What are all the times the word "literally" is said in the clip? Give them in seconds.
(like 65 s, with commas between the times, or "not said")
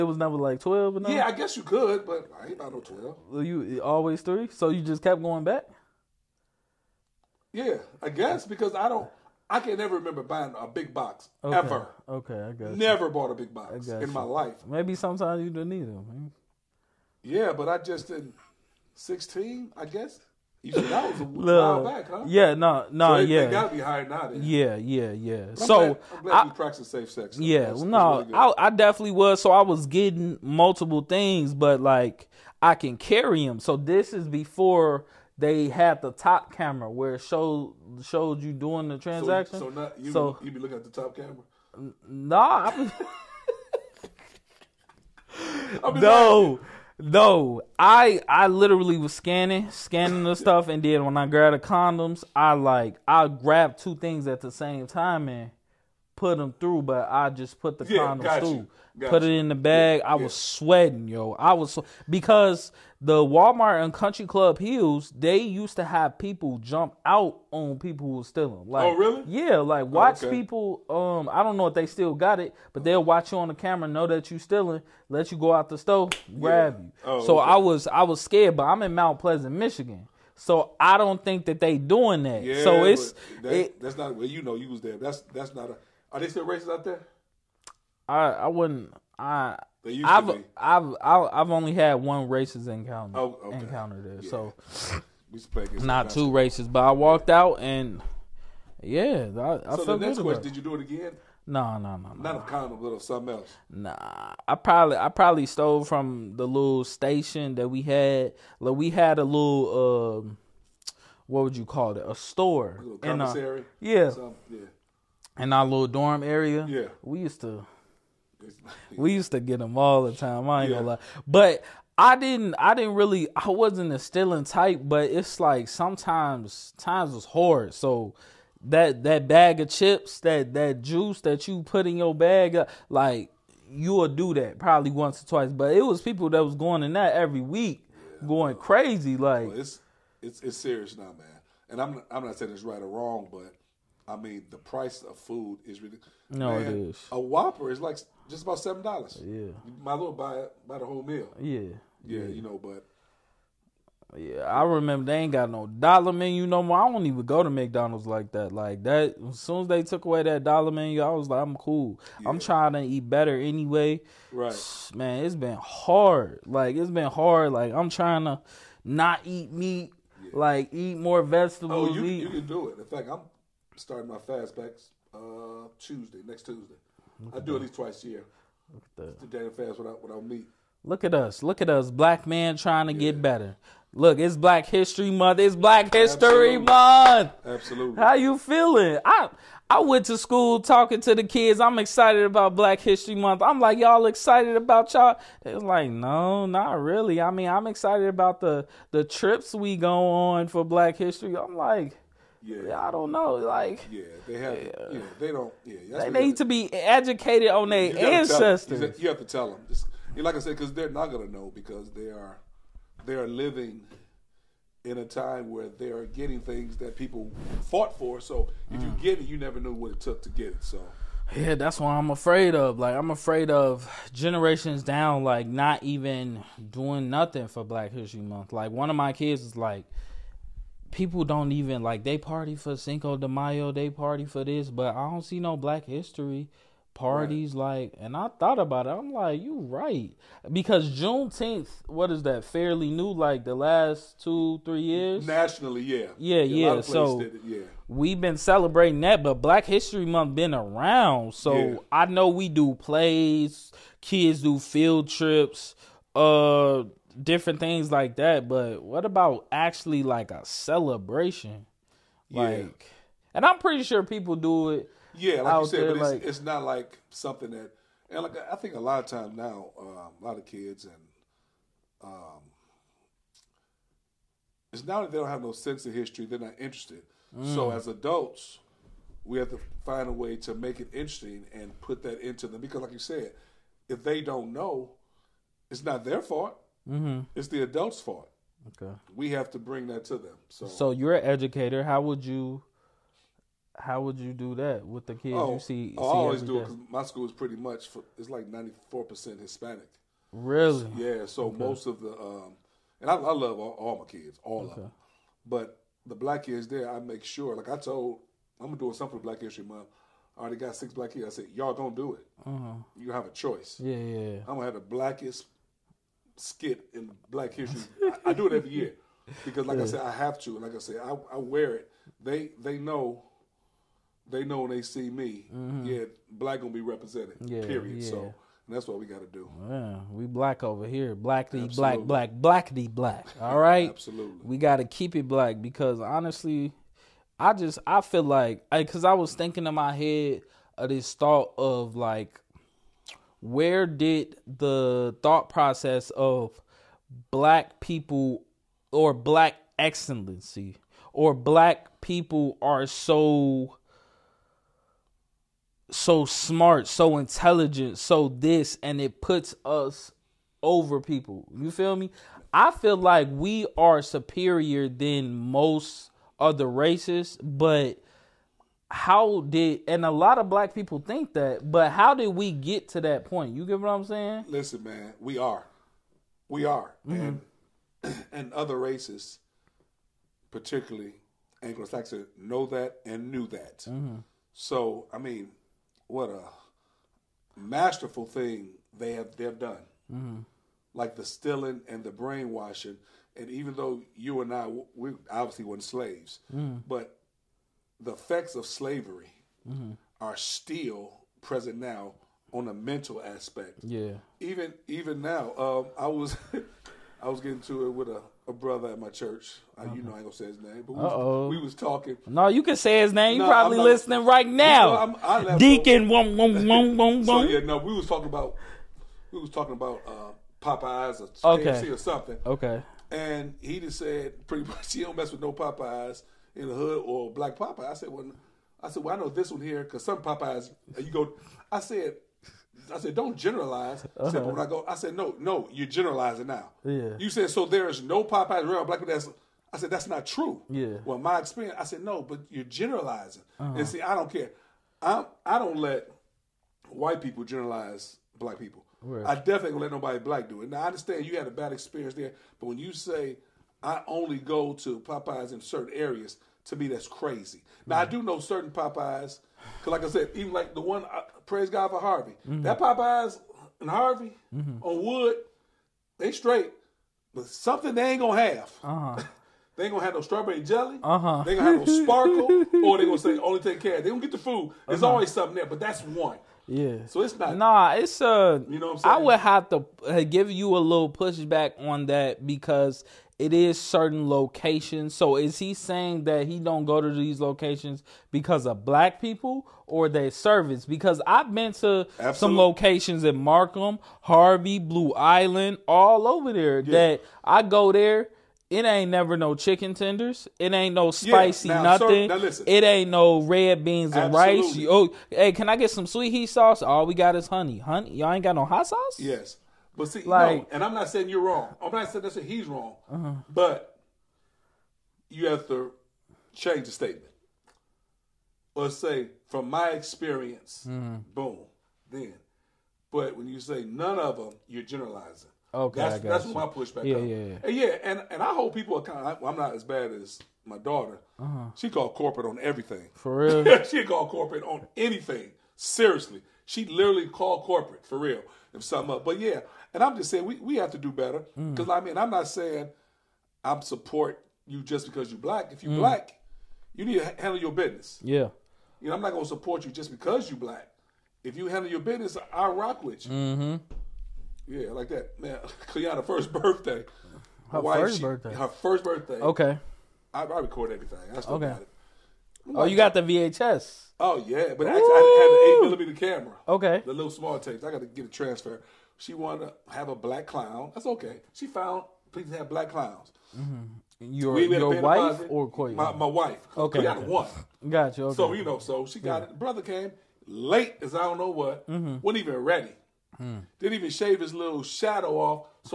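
48 s, 536 s.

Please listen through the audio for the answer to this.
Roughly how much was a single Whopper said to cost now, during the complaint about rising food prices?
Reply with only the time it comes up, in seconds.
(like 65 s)
148 s.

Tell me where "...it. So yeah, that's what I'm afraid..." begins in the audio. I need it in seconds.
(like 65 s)
220 s.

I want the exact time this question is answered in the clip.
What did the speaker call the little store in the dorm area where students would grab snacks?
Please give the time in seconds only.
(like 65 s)
112 s.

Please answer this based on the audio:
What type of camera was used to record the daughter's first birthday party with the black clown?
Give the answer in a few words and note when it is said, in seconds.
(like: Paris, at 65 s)
eight millimeter camera, at 565 s.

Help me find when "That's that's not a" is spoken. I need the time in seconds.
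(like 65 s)
84 s.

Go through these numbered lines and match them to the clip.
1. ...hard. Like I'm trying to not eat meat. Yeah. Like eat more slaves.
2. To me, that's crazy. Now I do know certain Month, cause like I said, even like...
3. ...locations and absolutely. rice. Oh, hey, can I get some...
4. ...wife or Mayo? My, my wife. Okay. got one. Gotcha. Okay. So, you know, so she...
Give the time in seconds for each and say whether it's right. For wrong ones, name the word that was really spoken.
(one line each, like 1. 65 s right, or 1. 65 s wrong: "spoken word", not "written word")
1. 167 s wrong: "vegetables", not "slaves"
2. 456 s wrong: "Popeyes", not "Month"
3. 503 s wrong: "beans", not "locations"
4. 574 s wrong: "Koya", not "Mayo".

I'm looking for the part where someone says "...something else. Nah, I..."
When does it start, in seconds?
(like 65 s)
103 s.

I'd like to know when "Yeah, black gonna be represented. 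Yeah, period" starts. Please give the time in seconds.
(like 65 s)
325 s.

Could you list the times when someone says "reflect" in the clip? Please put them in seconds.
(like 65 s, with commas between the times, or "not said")
not said.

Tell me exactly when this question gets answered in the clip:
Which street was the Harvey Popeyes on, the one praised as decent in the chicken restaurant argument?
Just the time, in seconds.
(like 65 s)
464 s.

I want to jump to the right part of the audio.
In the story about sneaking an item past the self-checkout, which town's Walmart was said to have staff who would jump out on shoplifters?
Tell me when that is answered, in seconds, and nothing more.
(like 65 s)
63 s.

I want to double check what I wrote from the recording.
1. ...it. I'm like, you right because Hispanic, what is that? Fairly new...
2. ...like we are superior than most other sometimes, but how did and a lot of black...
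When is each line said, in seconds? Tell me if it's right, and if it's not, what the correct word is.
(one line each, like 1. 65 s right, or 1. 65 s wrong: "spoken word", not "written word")
1. 238 s wrong: "Juneteenth", not "Hispanic"
2. 362 s wrong: "races", not "sometimes".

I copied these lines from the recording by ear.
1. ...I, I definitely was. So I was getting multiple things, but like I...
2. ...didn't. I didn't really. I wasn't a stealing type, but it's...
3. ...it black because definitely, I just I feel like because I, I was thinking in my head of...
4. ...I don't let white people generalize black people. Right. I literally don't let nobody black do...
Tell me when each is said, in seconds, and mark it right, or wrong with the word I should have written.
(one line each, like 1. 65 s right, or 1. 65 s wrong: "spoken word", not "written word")
1. 28 s right
2. 122 s right
3. 335 s wrong: "honestly", not "definitely"
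4. 445 s wrong: "definitely", not "literally".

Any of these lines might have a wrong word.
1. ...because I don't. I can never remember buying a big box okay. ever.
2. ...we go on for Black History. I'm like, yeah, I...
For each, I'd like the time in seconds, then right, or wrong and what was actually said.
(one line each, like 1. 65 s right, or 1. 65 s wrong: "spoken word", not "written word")
1. 8 s right
2. 199 s right.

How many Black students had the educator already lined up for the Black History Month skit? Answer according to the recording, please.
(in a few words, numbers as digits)
6.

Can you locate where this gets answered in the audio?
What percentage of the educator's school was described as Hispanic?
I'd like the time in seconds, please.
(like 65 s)
298 s.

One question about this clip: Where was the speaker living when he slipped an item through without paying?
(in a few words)
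Mount Pleasant, Michigan.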